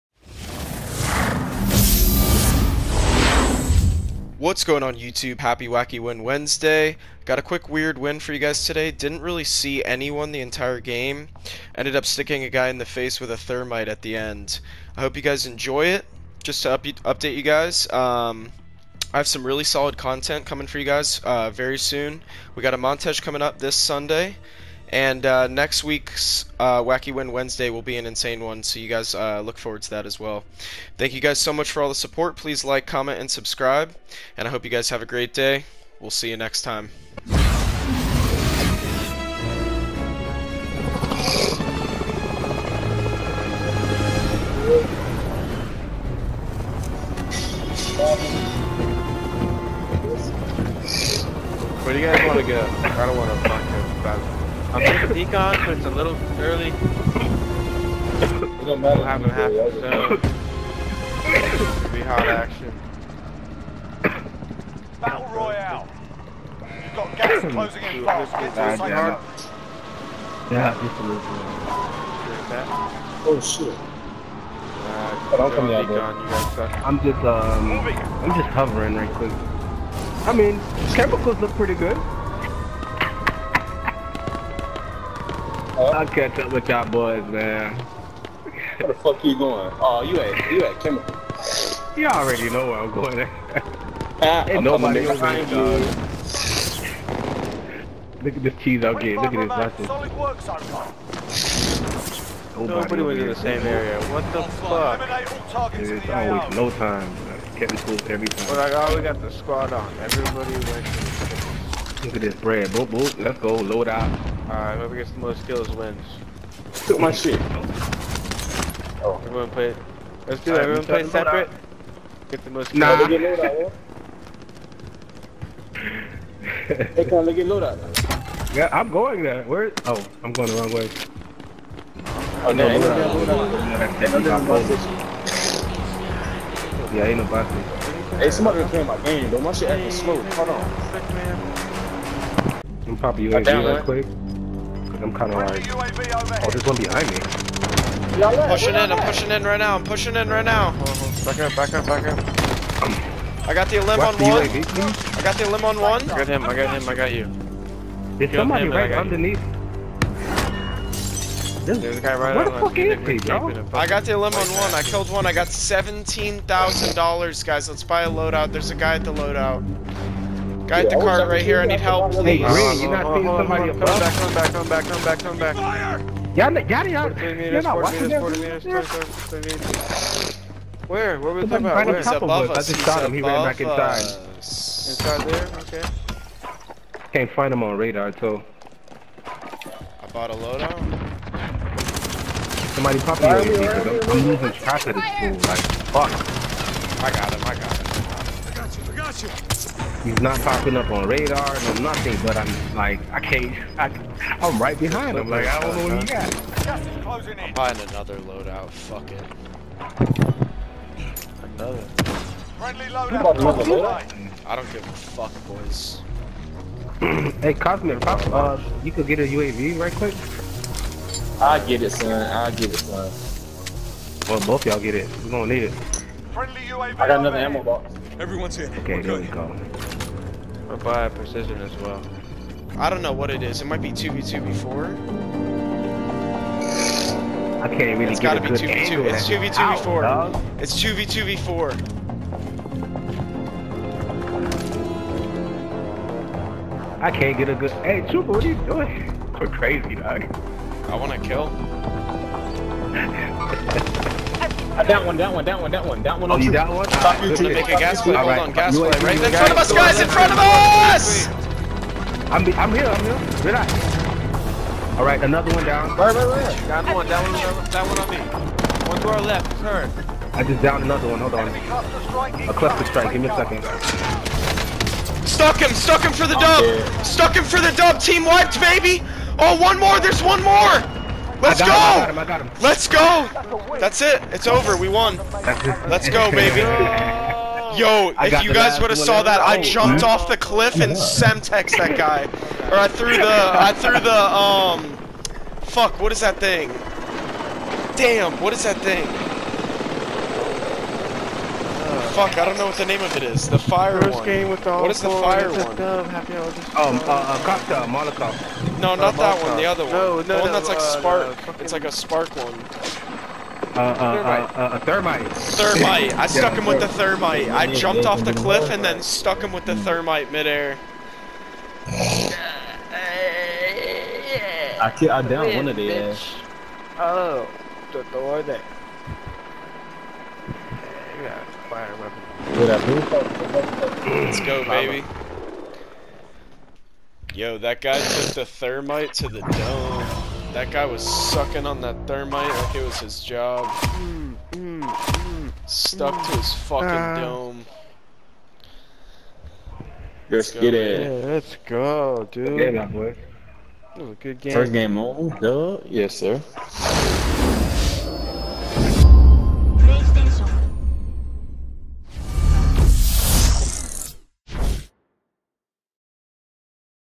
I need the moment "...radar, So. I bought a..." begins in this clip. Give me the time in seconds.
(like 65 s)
187 s.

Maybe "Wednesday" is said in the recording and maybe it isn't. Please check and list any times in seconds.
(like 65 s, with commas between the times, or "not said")
6 s, 27 s.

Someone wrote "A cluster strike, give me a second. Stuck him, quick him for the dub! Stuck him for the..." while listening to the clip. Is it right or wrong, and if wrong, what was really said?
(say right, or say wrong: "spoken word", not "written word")
wrong: "stuck", not "quick".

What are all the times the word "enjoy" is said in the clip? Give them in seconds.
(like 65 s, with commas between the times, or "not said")
15 s.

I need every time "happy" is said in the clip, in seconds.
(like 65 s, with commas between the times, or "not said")
5 s, 306 s.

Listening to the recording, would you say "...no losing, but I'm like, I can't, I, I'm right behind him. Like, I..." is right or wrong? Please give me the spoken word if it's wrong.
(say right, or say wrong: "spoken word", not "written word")
wrong: "nothing", not "losing".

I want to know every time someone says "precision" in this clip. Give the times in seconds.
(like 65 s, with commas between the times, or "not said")
231 s.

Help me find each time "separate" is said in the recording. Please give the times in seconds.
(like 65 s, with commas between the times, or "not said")
121 s.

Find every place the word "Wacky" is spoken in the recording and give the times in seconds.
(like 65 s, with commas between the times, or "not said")
5 s, 26 s.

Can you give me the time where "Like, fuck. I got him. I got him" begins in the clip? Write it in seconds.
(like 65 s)
195 s.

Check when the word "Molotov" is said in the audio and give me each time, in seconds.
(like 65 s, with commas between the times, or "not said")
307 s.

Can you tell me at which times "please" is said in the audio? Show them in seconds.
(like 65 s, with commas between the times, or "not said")
32 s, 172 s.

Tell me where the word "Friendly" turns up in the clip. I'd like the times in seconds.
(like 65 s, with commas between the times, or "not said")
212 s, 226 s.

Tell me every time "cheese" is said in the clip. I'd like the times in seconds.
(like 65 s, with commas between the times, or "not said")
98 s.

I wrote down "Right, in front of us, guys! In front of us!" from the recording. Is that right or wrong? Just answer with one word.
right.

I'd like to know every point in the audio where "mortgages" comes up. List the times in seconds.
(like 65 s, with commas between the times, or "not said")
not said.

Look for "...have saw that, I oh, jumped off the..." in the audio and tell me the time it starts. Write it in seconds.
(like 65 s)
288 s.